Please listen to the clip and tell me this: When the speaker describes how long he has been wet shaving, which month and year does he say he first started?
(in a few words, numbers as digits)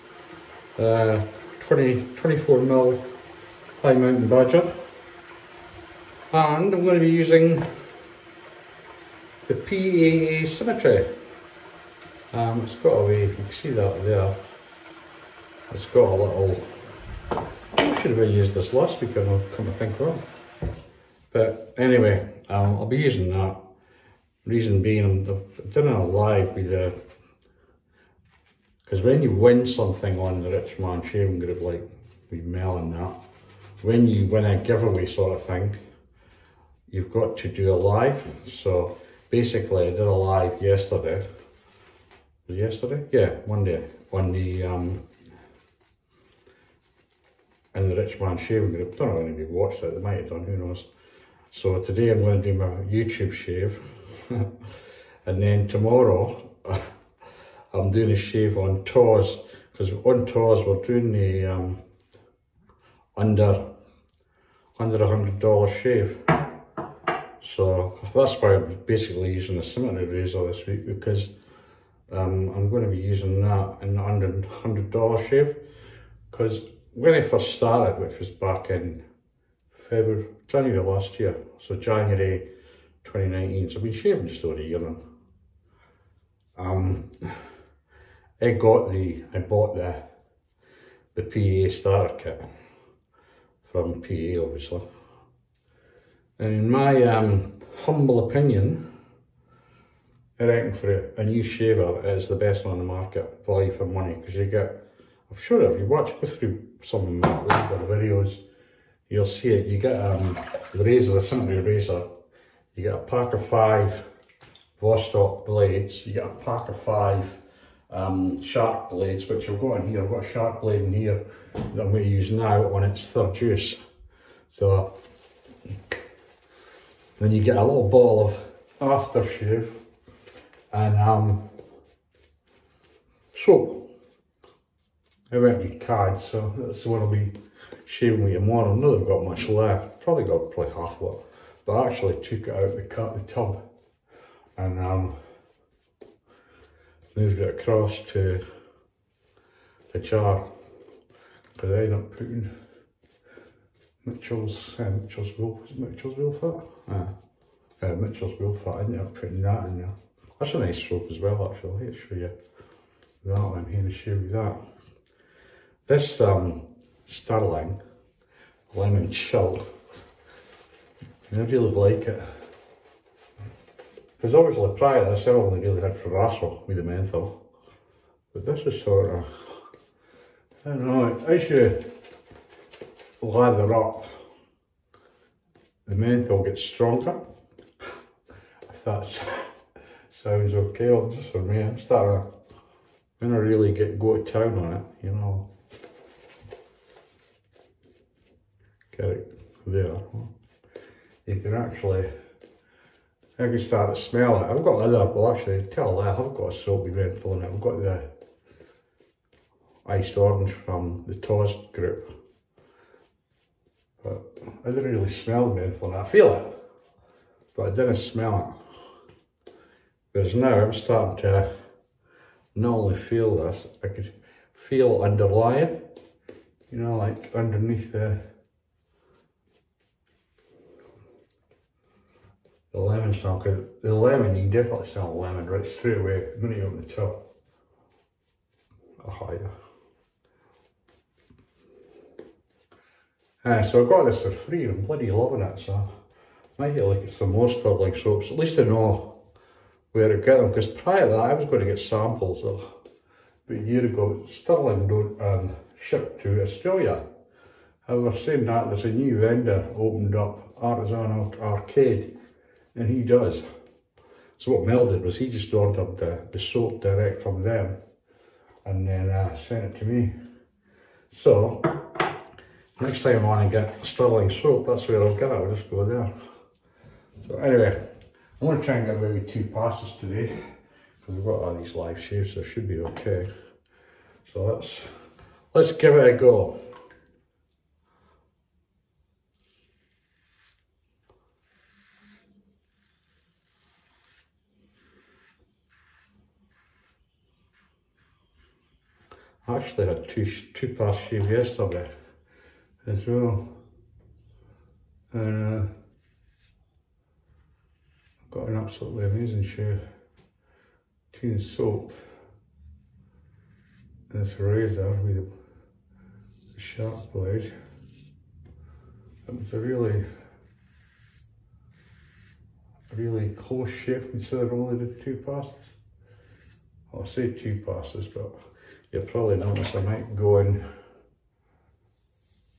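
January 2019.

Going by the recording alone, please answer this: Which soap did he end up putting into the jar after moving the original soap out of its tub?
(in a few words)
Mitchell's Wool Fat.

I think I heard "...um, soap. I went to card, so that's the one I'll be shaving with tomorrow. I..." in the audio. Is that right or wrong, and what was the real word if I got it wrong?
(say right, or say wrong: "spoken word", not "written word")
right.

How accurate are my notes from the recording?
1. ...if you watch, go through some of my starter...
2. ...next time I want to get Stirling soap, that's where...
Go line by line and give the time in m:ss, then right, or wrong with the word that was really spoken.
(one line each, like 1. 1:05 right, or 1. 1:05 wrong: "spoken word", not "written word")
1. 1:45 wrong: "older", not "starter"
2. 4:32 right.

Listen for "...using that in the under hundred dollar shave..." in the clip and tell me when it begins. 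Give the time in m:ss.
1:13.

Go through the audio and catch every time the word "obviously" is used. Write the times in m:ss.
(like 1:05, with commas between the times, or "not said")
1:34, 2:54.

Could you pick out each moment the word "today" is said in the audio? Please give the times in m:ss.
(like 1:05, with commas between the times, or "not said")
0:51, 4:39.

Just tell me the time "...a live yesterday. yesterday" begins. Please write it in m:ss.
0:39.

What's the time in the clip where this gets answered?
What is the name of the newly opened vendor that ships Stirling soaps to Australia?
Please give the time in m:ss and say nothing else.
4:20.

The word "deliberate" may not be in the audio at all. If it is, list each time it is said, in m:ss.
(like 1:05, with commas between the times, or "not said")
not said.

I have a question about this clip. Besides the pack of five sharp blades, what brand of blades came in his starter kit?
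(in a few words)
Vostok.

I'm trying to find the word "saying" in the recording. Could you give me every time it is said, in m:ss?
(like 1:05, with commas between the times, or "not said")
4:18.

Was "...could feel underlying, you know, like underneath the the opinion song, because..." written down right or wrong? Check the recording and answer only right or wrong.
wrong.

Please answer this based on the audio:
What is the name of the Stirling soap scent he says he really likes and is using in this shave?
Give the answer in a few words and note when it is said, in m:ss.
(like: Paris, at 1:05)
Lemon Chill, at 2:48.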